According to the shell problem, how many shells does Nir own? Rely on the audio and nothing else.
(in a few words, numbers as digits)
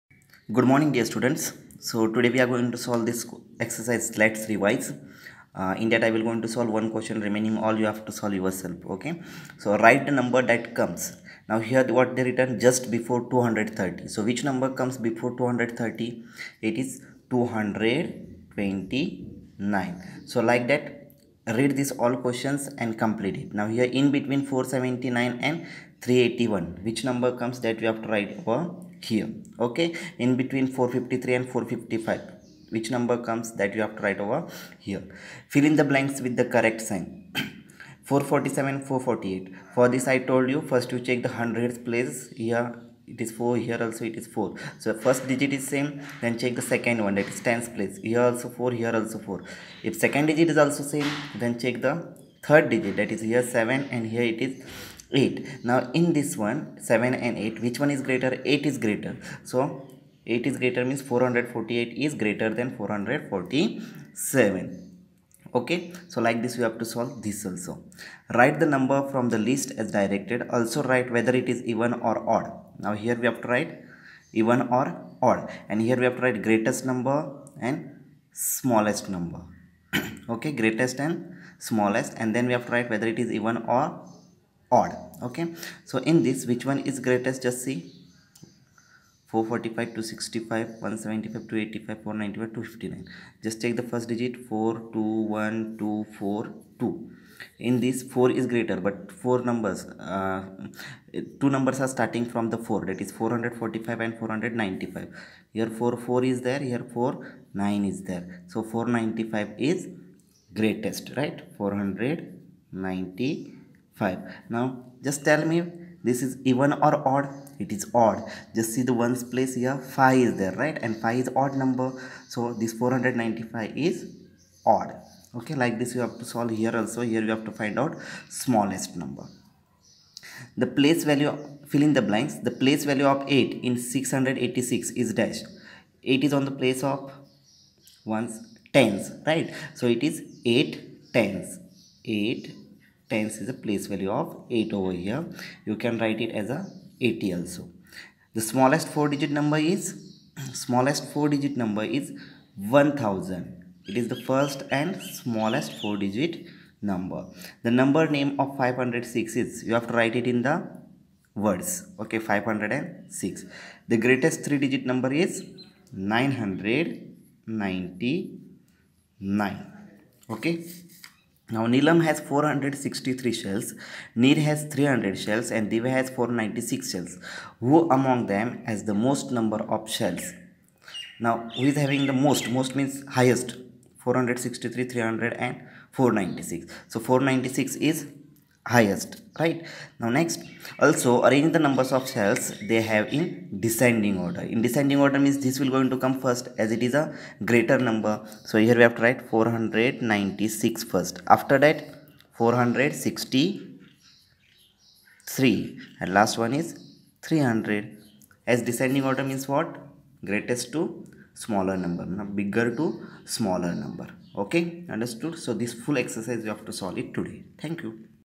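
300.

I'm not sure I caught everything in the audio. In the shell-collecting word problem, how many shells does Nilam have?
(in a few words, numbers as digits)
463.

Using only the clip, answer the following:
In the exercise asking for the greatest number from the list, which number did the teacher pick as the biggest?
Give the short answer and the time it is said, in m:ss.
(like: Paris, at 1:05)
495, at 1:48.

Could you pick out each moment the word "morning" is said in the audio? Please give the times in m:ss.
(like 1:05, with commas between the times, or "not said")
0:00.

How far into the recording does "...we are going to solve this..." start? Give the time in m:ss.
0:02.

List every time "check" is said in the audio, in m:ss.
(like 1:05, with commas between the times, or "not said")
0:41, 0:46, 0:51.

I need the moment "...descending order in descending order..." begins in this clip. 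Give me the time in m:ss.
3:13.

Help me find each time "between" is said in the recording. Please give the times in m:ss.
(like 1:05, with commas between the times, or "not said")
0:24, 0:30.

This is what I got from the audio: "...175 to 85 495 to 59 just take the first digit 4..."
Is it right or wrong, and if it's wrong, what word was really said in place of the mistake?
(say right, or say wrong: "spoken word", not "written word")
right.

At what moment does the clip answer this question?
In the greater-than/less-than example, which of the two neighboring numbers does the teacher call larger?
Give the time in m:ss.
1:01.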